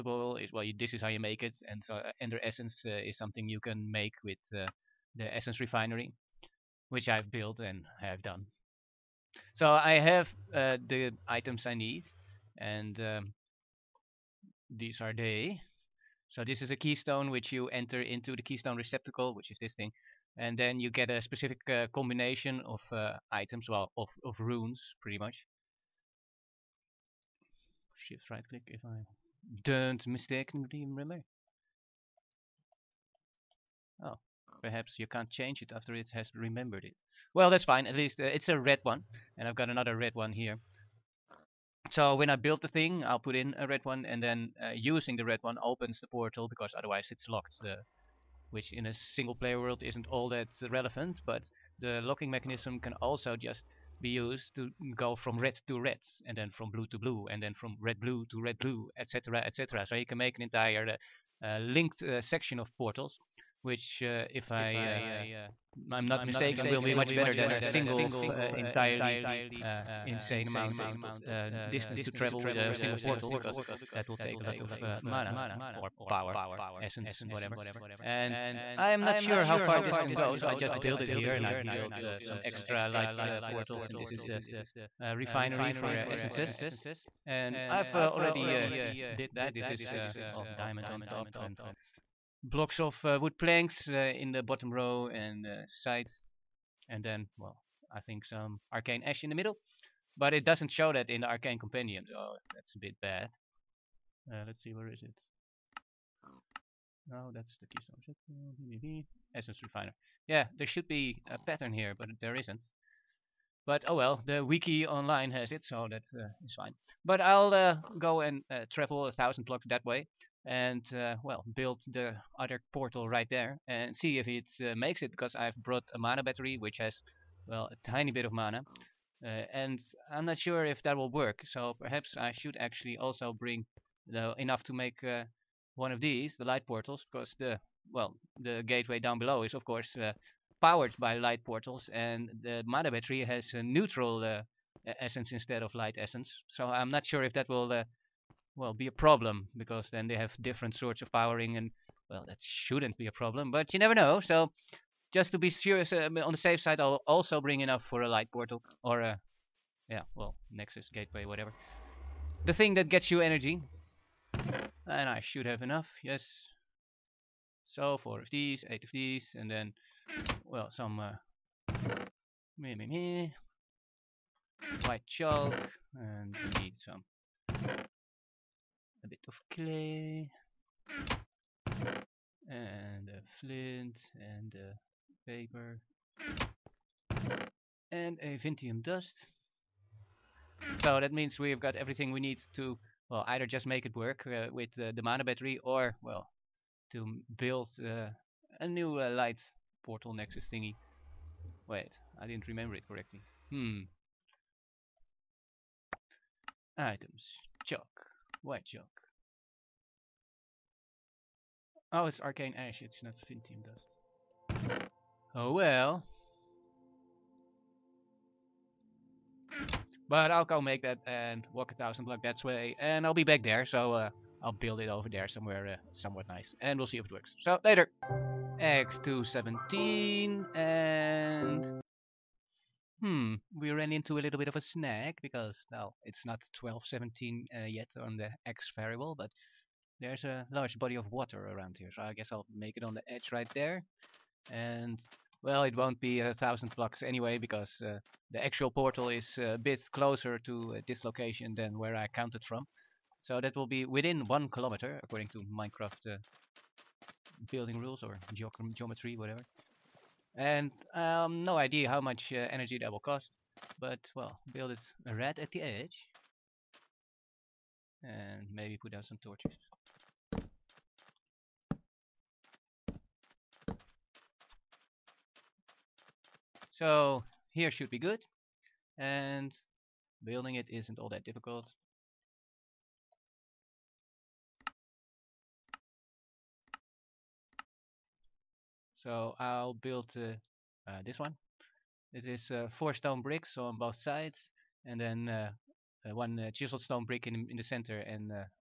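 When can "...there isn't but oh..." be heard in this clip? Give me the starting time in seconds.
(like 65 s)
112 s.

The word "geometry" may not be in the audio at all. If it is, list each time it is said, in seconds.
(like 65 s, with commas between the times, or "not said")
258 s.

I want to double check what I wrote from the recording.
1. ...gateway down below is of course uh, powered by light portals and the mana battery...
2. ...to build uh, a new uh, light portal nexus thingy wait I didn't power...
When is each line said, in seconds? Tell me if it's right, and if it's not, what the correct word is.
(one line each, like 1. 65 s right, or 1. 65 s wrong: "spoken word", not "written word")
1. 138 s right
2. 196 s wrong: "remember", not "power".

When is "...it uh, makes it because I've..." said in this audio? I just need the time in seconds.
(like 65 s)
124 s.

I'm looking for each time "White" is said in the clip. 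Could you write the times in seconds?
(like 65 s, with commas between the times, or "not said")
174 s, 208 s.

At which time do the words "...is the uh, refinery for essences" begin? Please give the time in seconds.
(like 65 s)
84 s.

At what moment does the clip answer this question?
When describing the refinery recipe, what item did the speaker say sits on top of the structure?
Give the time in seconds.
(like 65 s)
90 s.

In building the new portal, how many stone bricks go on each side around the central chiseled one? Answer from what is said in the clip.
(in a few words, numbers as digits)
4.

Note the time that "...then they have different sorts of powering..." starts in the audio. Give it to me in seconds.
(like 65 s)
149 s.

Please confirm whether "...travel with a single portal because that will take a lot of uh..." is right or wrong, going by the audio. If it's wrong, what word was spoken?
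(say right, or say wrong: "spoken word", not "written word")
right.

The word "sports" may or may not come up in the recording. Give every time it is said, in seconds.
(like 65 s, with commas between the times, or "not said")
not said.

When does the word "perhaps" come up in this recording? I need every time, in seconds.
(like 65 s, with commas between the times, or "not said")
34 s, 131 s.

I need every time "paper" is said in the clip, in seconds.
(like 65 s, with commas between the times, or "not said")
185 s.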